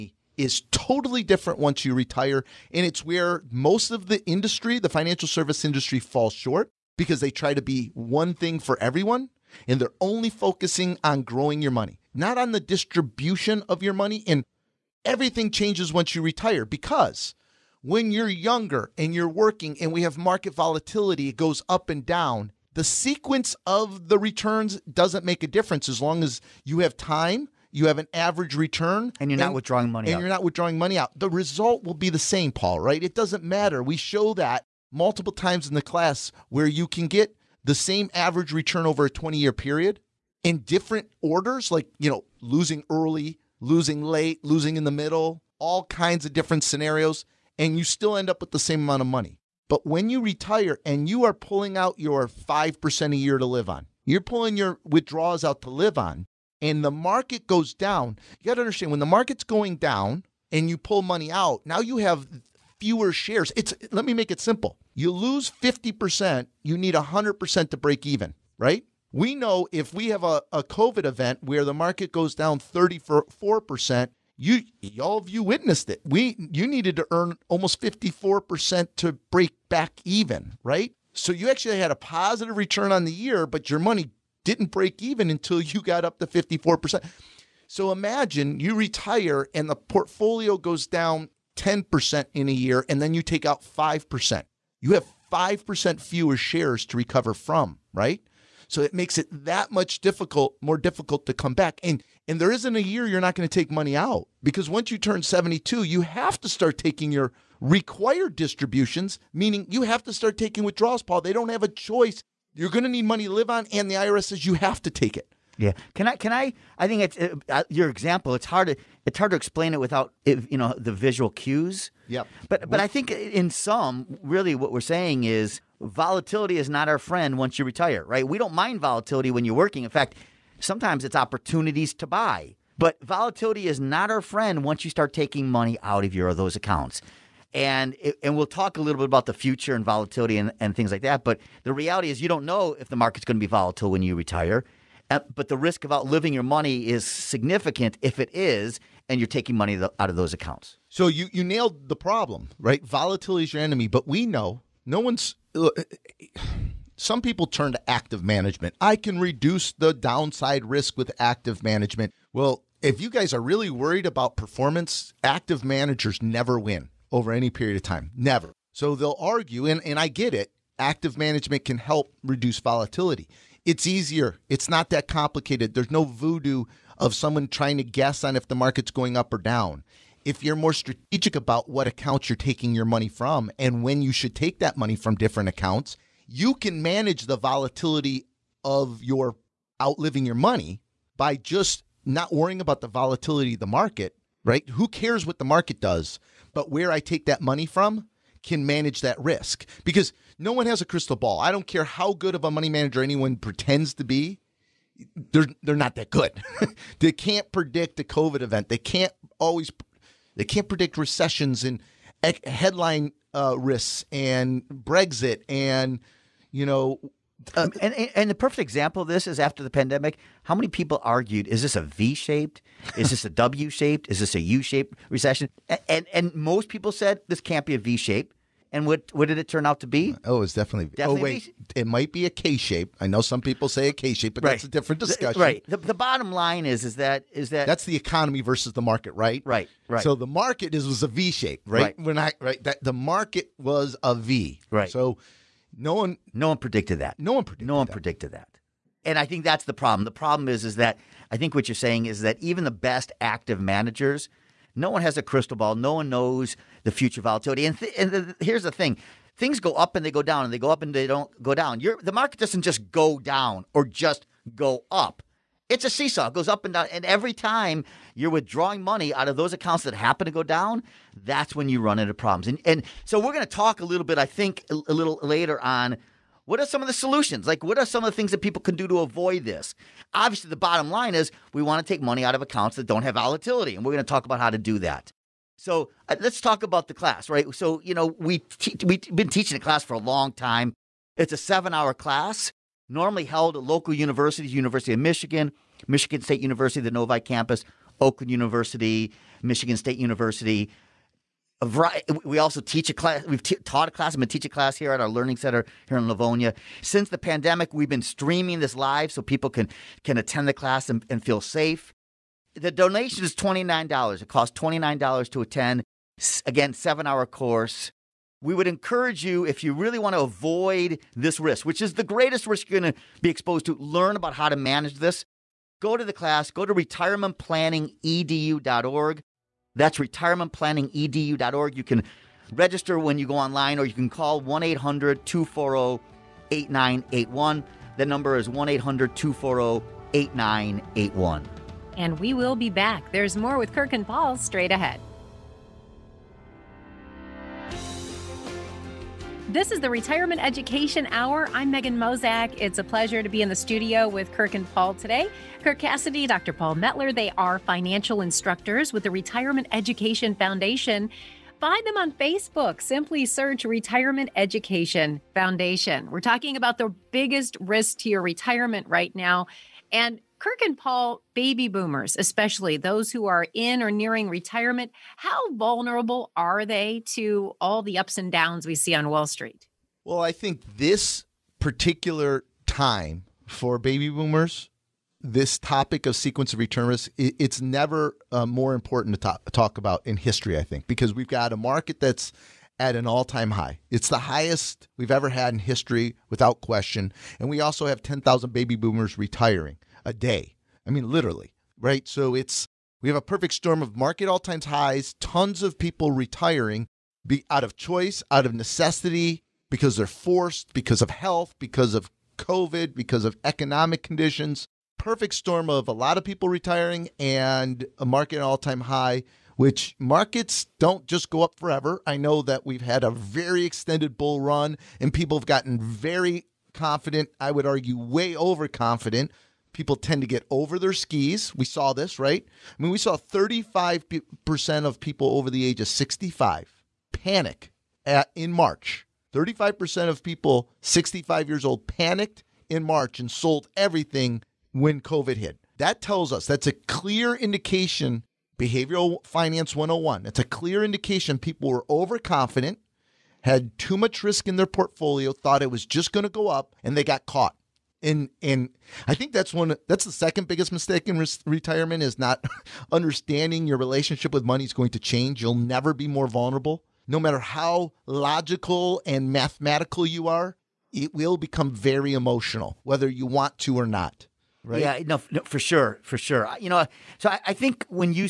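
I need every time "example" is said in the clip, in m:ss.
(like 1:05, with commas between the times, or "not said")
1:57, 3:38.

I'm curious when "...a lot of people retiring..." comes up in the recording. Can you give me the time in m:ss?
6:55.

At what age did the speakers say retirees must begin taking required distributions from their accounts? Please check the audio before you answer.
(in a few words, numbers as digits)
72.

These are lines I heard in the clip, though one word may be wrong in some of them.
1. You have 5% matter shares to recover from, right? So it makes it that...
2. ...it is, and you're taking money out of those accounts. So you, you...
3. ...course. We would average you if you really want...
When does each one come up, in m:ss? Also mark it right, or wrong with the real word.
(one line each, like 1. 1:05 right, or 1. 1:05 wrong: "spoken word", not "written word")
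1. 1:34 wrong: "fewer", not "matter"
2. 2:28 right
3. 5:17 wrong: "encourage", not "average".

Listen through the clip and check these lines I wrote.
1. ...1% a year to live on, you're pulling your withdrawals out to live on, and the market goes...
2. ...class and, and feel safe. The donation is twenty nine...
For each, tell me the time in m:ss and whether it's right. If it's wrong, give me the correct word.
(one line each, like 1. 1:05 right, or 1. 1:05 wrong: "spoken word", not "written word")
1. 0:52 wrong: "5", not "1"
2. 5:10 right.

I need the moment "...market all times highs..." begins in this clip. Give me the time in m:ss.
6:43.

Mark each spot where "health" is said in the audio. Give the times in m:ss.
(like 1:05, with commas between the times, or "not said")
6:51.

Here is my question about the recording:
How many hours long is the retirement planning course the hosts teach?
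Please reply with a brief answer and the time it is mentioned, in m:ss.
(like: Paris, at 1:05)
7, at 4:51.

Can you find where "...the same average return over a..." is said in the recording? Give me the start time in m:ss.
0:37.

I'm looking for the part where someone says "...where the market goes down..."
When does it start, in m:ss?
1:11.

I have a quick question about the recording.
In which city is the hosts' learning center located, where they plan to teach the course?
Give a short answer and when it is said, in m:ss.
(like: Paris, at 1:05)
Livonia, at 5:06.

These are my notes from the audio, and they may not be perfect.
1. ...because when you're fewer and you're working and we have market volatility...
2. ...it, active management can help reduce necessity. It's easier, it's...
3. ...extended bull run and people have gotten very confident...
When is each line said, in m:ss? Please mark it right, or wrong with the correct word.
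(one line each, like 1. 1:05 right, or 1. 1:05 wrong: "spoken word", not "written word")
1. 0:16 wrong: "younger", not "fewer"
2. 2:50 wrong: "volatility", not "necessity"
3. 7:03 right.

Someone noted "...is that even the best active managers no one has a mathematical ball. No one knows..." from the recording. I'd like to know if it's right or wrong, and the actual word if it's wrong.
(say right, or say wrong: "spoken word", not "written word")
wrong: "crystal", not "mathematical".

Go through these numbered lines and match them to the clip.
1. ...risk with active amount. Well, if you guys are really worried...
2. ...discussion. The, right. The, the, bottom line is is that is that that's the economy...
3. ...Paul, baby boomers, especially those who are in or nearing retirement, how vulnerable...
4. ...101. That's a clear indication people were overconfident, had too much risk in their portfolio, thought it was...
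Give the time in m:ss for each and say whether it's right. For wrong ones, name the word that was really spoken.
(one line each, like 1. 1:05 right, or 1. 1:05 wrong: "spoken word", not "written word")
1. 2:40 wrong: "management", not "amount"
2. 3:54 right
3. 6:10 right
4. 7:29 right.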